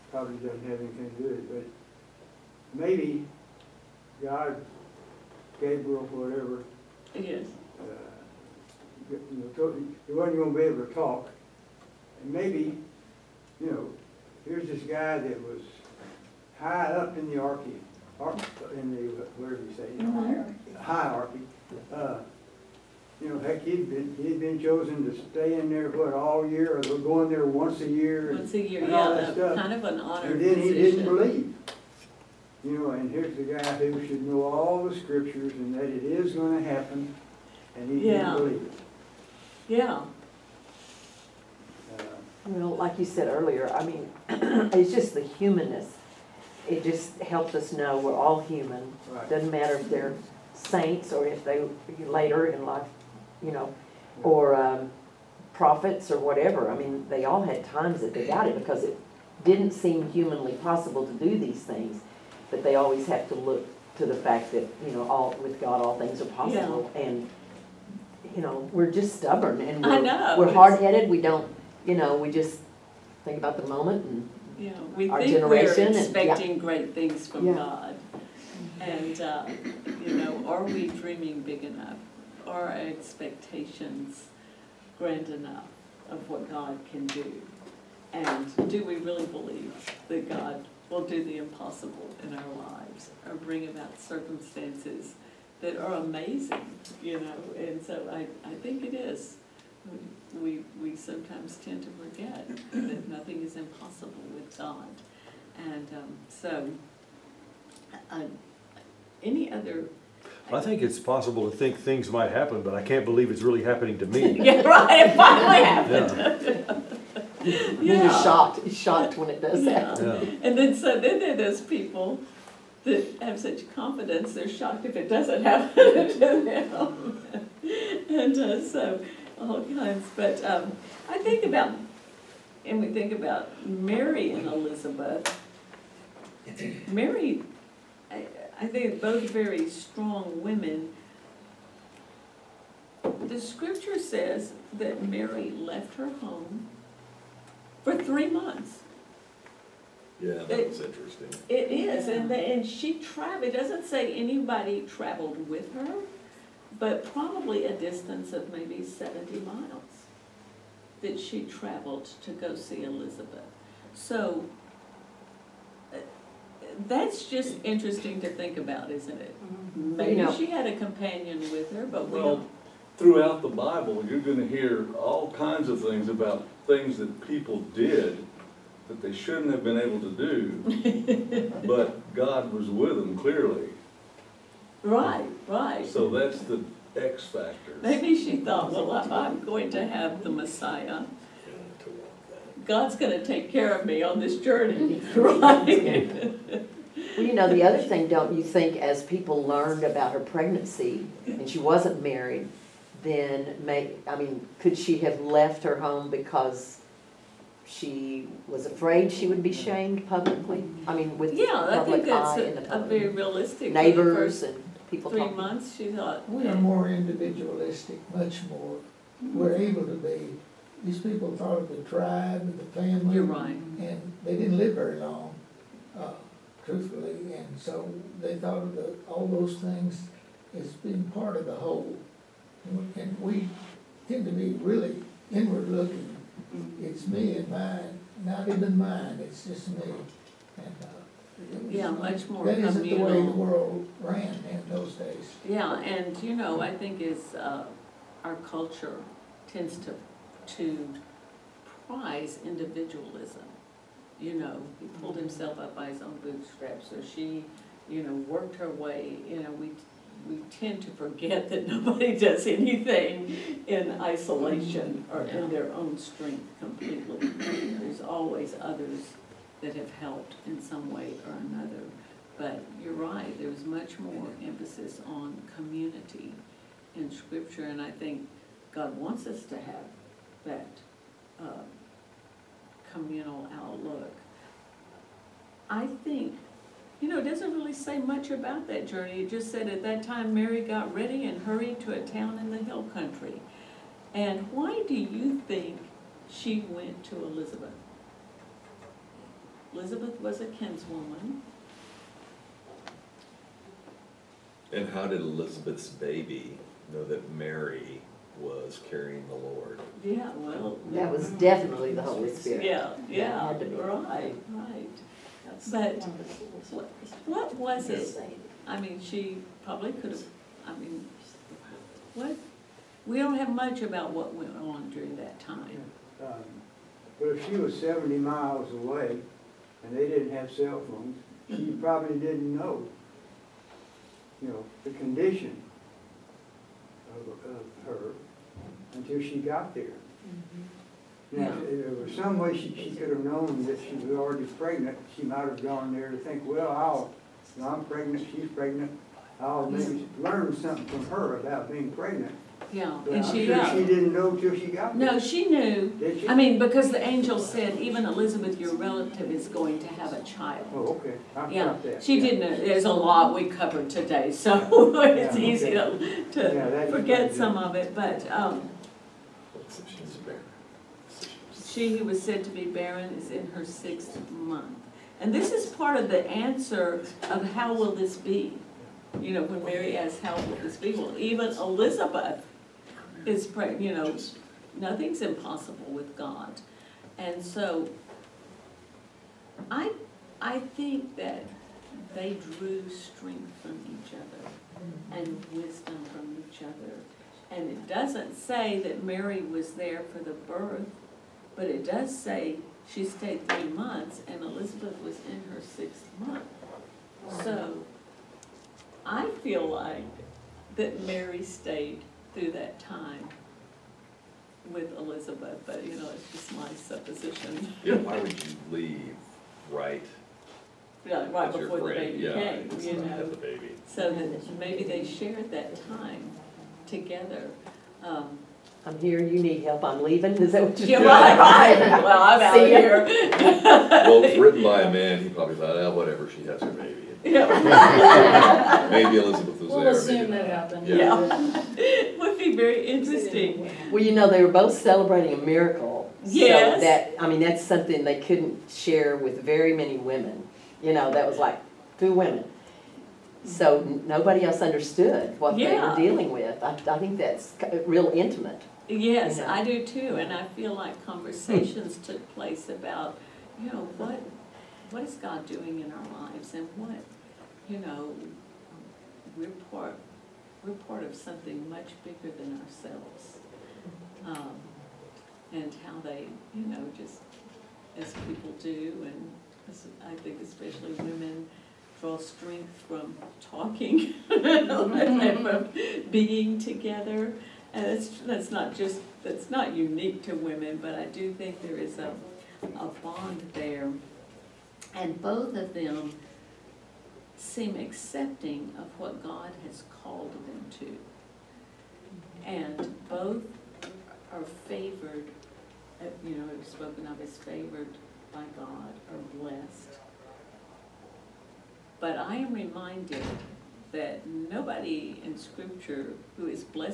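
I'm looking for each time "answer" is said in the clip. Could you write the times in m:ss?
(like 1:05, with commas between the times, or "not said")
6:16.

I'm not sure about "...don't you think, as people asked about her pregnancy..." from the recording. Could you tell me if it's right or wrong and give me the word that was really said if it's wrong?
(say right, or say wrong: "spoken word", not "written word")
wrong: "learned", not "asked".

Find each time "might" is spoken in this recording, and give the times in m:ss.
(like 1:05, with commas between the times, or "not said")
1:52, 5:45.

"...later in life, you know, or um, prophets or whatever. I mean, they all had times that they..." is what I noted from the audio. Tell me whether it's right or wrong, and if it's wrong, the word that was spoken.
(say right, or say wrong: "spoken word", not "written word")
right.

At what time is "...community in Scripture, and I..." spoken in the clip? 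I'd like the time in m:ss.
4:35.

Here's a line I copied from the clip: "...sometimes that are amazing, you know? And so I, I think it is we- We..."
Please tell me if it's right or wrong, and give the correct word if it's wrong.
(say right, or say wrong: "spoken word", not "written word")
wrong: "circumstances", not "sometimes".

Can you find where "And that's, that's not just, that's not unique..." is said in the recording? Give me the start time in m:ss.
8:07.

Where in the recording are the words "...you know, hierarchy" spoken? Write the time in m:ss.
0:19.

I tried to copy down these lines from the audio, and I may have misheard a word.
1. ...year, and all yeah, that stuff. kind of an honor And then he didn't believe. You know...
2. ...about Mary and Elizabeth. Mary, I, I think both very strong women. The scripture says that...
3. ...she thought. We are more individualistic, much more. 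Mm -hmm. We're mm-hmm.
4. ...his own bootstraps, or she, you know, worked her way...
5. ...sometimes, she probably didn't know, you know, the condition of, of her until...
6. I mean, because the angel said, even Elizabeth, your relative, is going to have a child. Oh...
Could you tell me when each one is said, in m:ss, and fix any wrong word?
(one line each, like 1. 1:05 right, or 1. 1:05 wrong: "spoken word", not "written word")
1. 0:28 right
2. 2:13 right
3. 3:35 right
4. 4:15 right
5. 5:30 wrong: "phones", not "sometimes"
6. 5:56 right.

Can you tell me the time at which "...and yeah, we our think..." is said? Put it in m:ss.
1:14.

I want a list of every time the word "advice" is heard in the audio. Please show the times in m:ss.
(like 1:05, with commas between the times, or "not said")
not said.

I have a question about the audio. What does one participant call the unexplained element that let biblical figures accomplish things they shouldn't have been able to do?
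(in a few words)
the X factor.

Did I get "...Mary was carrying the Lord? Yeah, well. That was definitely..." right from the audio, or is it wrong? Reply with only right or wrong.
right.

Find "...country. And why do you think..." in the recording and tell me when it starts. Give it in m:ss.
4:52.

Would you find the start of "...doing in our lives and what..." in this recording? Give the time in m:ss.
7:45.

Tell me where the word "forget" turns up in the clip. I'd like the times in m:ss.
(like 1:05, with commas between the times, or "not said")
1:42, 4:20, 6:06.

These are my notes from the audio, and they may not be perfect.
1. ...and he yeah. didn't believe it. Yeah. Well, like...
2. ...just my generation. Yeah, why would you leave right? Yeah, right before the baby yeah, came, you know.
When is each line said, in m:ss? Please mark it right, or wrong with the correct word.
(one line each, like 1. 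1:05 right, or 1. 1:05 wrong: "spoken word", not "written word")
1. 0:37 right
2. 6:56 wrong: "supposition", not "generation".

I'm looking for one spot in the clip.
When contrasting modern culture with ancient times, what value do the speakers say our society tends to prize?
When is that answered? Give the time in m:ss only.
4:12.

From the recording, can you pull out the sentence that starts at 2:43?
So uh, that's just interesting to think about, isn't it?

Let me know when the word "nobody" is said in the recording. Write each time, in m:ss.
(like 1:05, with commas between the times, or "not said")
4:21, 7:34, 8:34.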